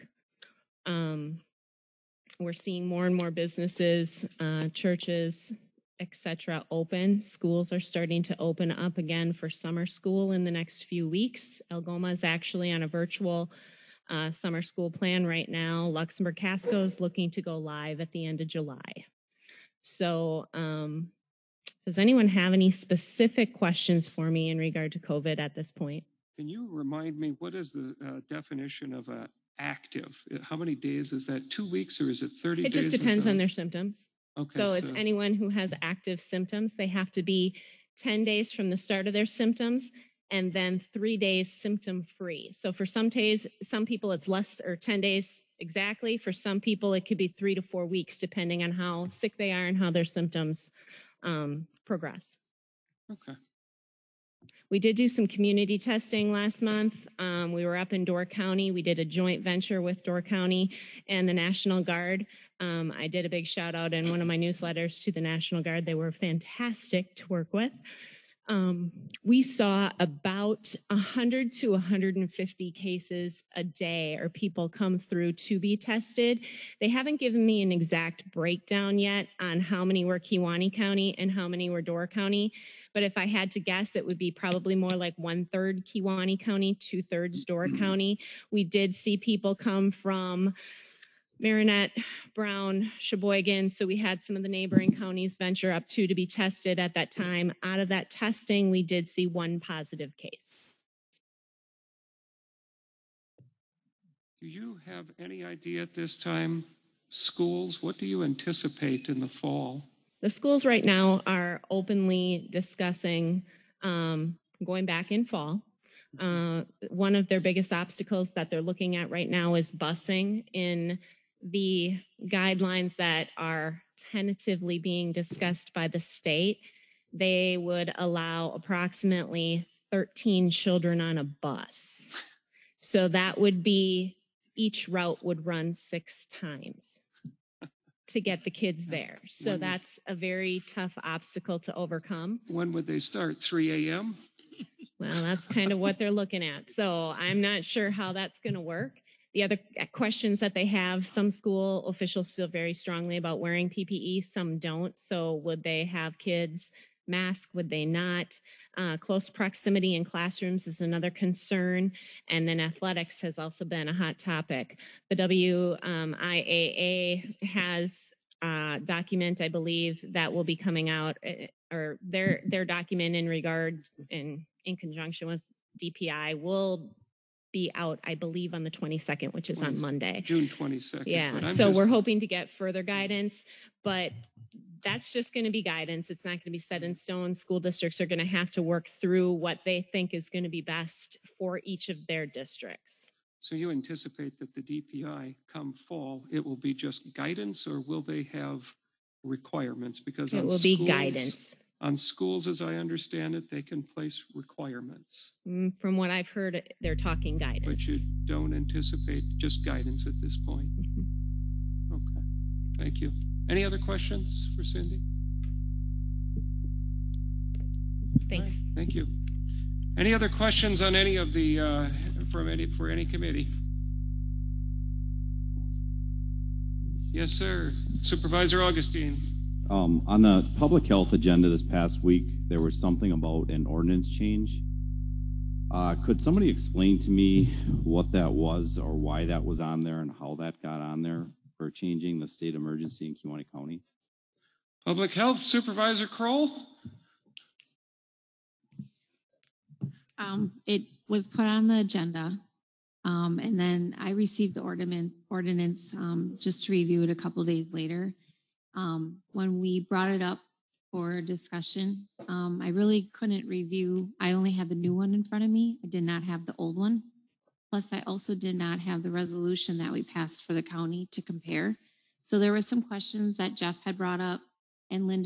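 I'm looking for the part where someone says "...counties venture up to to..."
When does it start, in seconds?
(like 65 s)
94 s.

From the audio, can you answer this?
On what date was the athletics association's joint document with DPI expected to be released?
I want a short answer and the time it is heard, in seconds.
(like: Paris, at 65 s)
June 22nd, at 180 s.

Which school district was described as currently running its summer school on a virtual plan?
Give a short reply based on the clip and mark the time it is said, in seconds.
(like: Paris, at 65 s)
Algoma, at 11 s.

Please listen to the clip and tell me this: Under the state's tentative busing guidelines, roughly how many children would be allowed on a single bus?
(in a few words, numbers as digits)
13.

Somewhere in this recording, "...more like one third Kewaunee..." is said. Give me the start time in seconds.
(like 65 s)
84 s.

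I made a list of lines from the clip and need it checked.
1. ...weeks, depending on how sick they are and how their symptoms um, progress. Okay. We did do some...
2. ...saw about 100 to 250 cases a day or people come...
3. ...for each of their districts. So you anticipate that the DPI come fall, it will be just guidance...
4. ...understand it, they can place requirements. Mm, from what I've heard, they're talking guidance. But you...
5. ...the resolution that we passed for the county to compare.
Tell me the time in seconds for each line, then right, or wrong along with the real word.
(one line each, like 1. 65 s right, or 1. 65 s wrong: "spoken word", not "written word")
1. 47 s right
2. 69 s wrong: "150", not "250"
3. 191 s right
4. 202 s right
5. 269 s right.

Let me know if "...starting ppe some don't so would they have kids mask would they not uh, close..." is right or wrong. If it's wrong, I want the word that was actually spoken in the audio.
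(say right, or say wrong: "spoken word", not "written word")
wrong: "wearing", not "starting".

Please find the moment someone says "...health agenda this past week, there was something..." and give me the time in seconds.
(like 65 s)
230 s.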